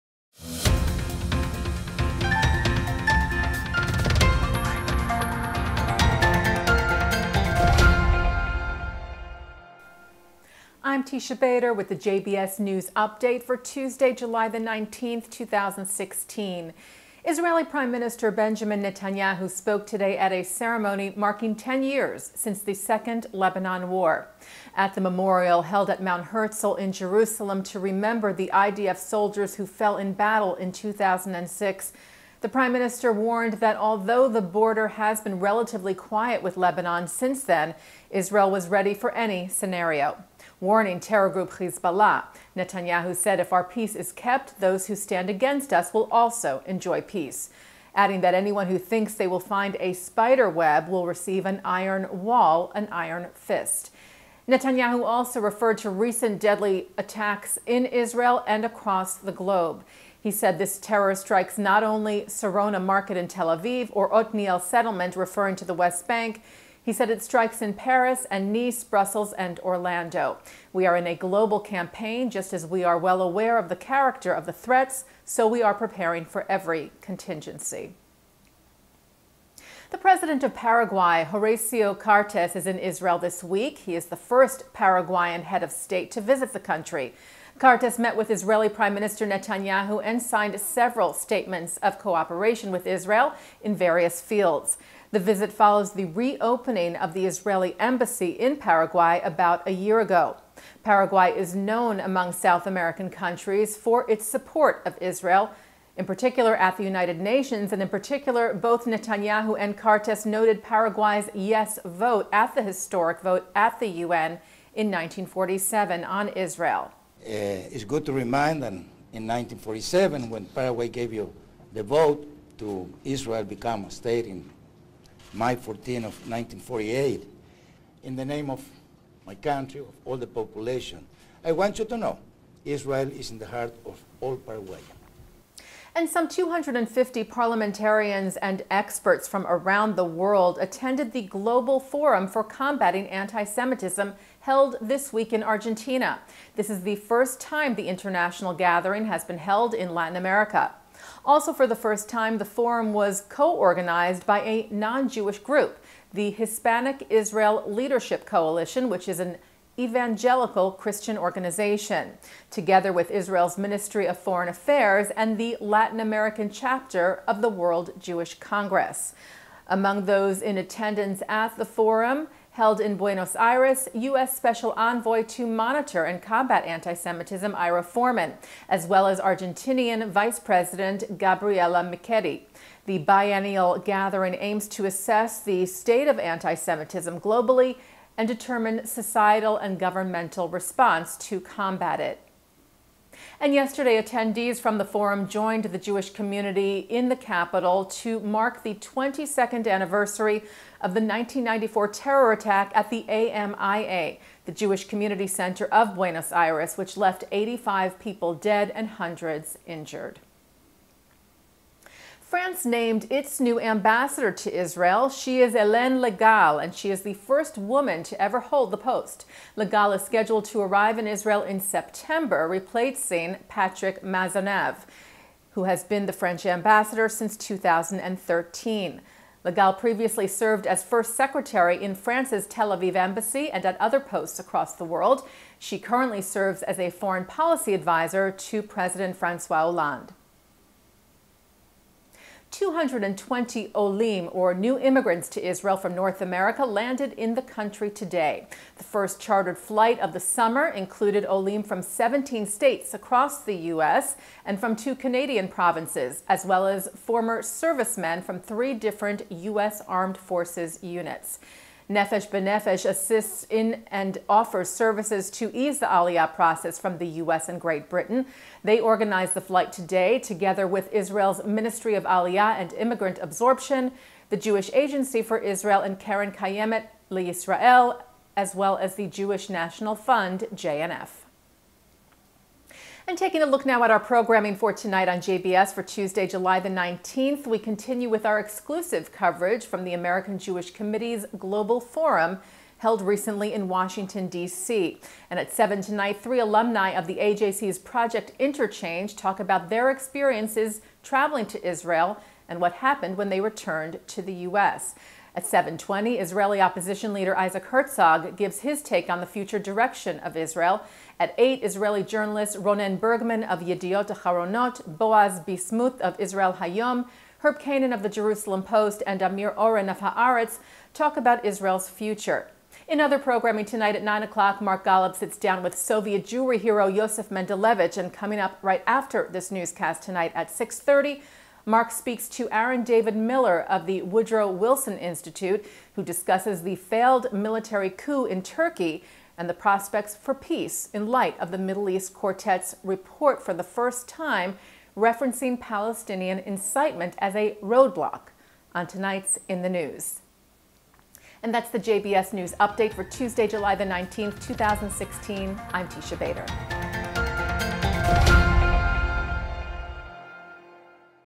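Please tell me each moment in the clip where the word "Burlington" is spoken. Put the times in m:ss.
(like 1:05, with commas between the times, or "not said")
not said.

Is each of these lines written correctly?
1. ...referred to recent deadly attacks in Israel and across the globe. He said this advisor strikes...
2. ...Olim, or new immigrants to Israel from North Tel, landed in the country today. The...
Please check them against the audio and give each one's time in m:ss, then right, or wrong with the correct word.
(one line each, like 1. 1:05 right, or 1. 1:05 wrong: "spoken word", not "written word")
1. 0:55 wrong: "terror", not "advisor"
2. 4:03 wrong: "America", not "Tel".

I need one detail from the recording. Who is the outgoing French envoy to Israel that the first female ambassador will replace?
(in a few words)
Patrick Maisonnave.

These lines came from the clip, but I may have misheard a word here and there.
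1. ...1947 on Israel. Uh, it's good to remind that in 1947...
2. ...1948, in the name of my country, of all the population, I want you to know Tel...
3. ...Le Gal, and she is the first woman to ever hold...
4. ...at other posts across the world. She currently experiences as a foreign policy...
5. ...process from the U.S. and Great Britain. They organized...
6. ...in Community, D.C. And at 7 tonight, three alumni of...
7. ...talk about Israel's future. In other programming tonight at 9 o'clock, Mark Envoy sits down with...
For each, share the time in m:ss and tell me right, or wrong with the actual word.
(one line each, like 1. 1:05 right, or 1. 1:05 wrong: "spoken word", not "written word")
1. 1:54 right
2. 2:06 wrong: "Israel", not "Tel"
3. 3:35 right
4. 3:53 wrong: "serves", not "experiences"
5. 4:26 right
6. 4:53 wrong: "Washington", not "Community"
7. 5:20 wrong: "Golub", not "Envoy".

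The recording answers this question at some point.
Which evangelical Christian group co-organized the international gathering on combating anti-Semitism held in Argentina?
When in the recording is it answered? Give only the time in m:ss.
2:36.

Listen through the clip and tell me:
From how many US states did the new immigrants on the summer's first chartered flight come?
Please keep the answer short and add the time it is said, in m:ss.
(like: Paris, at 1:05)
17, at 4:11.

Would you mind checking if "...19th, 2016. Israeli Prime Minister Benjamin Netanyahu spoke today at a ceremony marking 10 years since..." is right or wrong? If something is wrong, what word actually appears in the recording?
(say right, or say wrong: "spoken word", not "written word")
right.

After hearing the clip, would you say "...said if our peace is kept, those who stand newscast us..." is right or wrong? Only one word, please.
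wrong.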